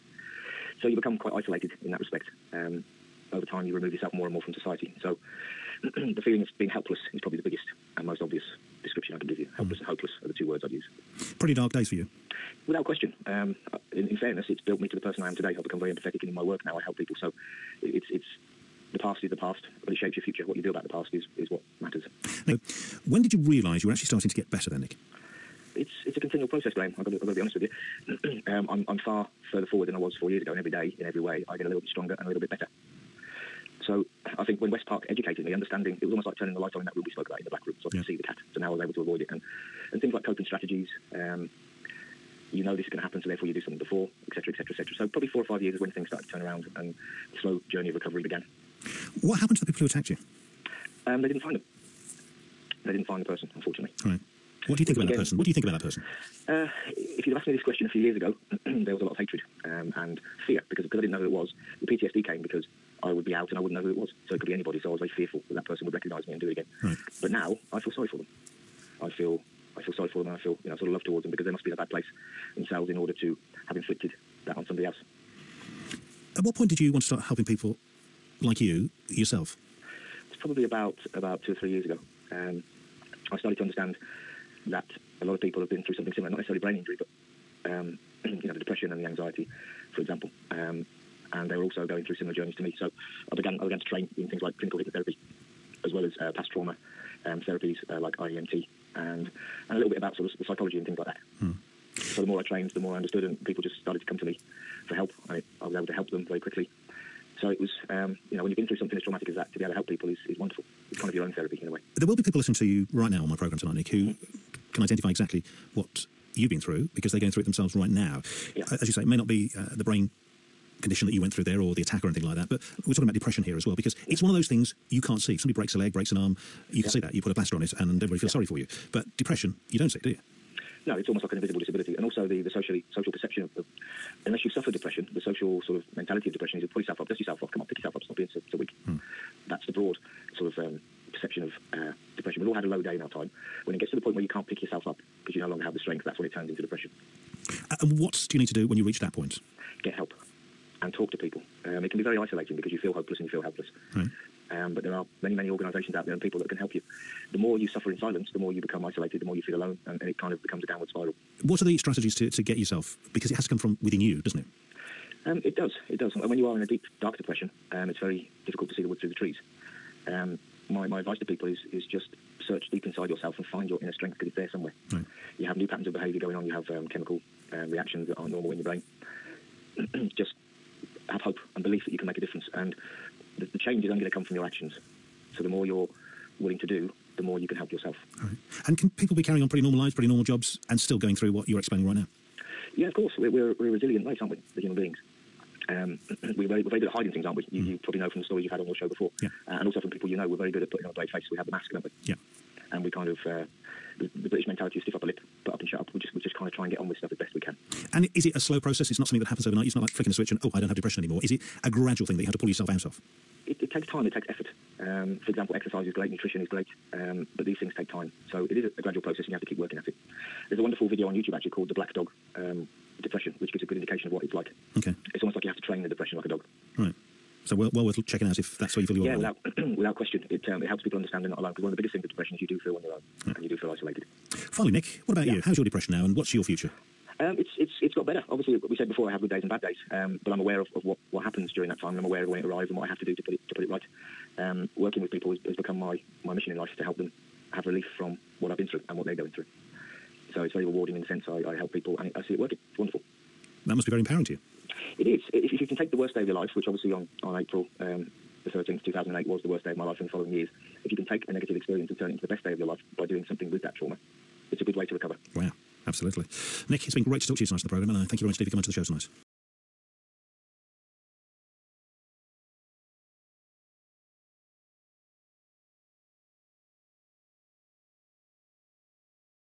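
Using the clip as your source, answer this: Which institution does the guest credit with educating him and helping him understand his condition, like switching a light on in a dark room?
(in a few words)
West Park.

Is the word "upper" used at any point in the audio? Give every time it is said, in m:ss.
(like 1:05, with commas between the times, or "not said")
3:24.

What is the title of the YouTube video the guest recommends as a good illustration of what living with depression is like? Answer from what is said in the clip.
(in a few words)
The Black Dog.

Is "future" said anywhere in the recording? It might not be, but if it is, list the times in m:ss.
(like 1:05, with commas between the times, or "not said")
0:20, 3:56.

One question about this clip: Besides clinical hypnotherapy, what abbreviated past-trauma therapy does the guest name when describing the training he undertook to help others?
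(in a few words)
IEMT.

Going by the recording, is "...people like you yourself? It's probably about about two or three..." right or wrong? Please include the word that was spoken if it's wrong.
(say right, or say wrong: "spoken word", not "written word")
right.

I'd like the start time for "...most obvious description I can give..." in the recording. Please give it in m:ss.
0:08.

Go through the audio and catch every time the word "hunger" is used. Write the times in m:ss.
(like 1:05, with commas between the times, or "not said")
not said.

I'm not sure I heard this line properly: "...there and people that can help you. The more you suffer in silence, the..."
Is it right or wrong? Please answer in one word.
right.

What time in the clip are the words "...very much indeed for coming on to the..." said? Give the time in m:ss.
4:28.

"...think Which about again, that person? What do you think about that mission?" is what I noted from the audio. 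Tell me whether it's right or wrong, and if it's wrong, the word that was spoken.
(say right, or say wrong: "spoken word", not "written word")
wrong: "person", not "mission".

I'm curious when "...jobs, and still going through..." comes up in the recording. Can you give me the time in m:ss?
3:10.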